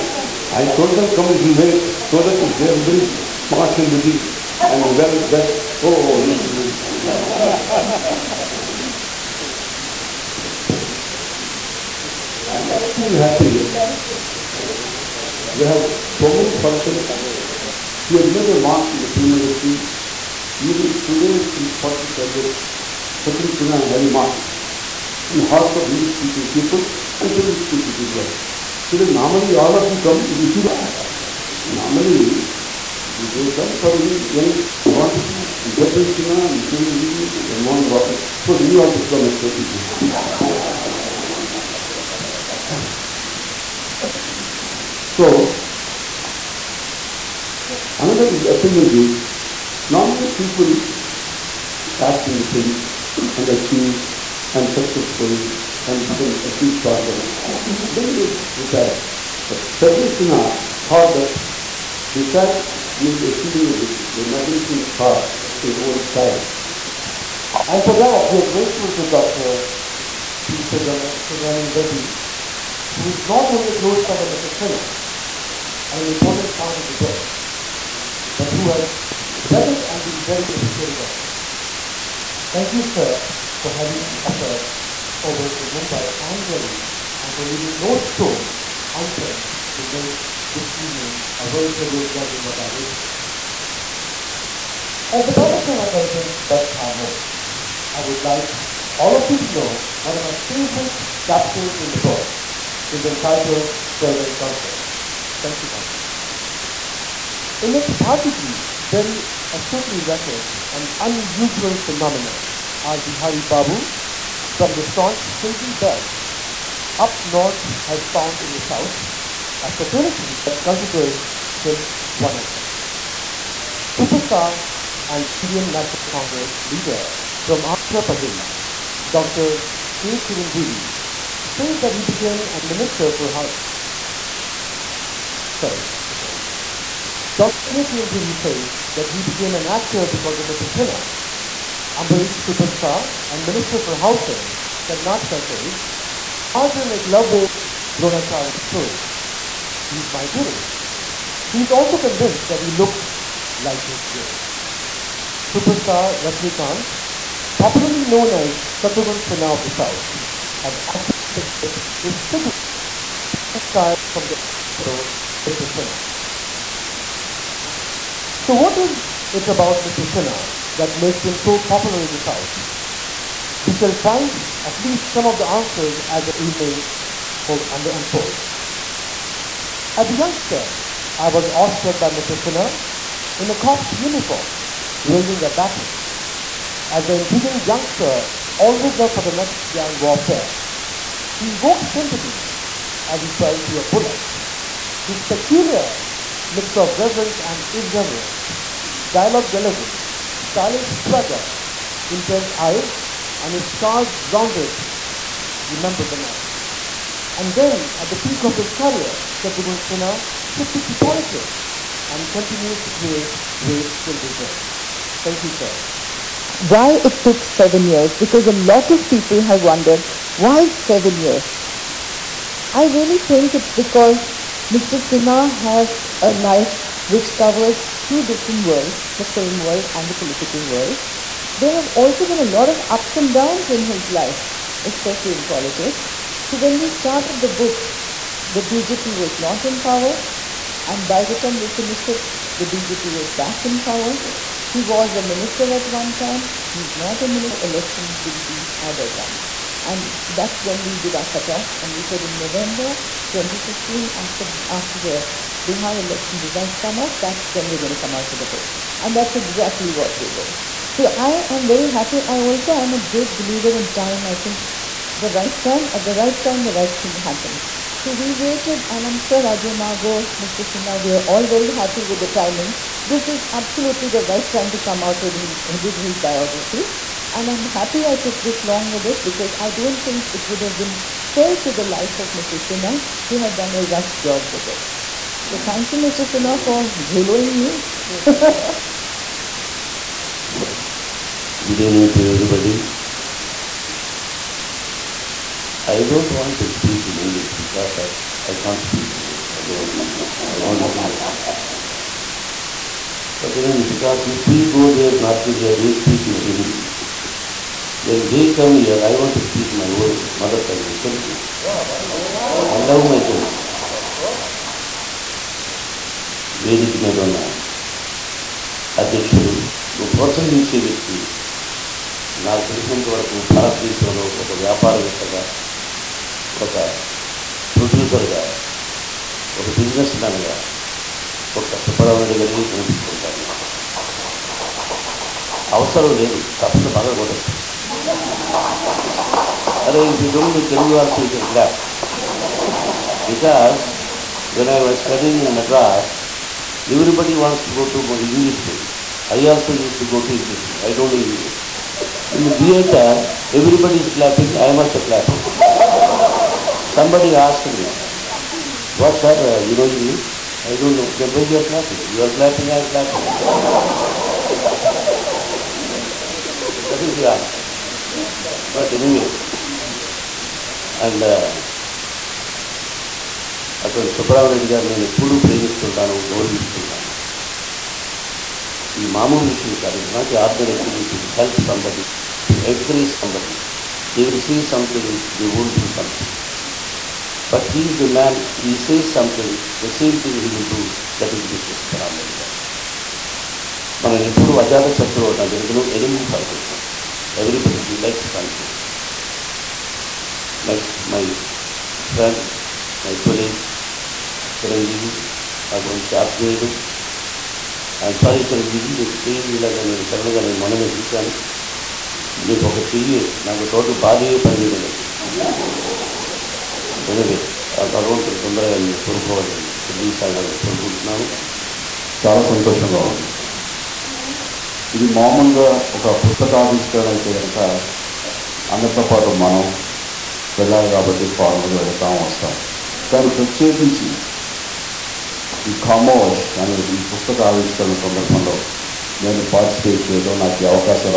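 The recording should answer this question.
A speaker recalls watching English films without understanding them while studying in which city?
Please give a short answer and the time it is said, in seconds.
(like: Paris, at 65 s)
Madras, at 345 s.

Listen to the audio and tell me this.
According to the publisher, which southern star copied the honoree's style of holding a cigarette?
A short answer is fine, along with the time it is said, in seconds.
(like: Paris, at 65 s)
Superstar Kant, at 155 s.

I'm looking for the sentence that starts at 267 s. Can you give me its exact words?
So we waited, and I'm sure Ajay Mago, Mr.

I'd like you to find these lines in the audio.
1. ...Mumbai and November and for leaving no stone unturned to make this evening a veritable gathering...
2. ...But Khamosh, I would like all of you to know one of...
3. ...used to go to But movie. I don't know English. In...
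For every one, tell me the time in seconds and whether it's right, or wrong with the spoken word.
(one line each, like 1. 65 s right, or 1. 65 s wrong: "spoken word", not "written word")
1. 85 s wrong: "Delhi", not "November"
2. 96 s right
3. 349 s wrong: "English", not "But".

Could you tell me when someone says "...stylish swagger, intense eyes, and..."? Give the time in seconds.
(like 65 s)
200 s.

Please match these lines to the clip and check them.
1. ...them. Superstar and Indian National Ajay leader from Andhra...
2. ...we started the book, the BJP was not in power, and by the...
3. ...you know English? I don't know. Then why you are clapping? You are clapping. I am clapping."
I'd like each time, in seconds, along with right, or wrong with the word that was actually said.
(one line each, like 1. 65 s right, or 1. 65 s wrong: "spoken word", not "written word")
1. 122 s wrong: "Congress", not "Ajay"
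2. 236 s right
3. 359 s right.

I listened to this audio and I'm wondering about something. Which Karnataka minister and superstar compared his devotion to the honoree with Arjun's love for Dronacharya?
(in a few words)
Ambarish.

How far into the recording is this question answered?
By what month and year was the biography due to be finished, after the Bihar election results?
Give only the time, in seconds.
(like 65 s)
252 s.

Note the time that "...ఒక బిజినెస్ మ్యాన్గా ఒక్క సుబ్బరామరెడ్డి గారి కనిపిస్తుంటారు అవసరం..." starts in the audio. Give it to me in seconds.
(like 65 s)
329 s.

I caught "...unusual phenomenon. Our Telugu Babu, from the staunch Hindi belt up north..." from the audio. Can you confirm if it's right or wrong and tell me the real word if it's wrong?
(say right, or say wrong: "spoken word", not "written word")
wrong: "Bihari", not "Telugu".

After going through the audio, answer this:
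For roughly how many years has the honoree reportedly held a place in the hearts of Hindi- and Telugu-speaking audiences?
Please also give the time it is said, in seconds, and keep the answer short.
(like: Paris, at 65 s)
45, at 21 s.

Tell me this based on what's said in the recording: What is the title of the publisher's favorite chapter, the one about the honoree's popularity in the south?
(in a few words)
Southern Comfort.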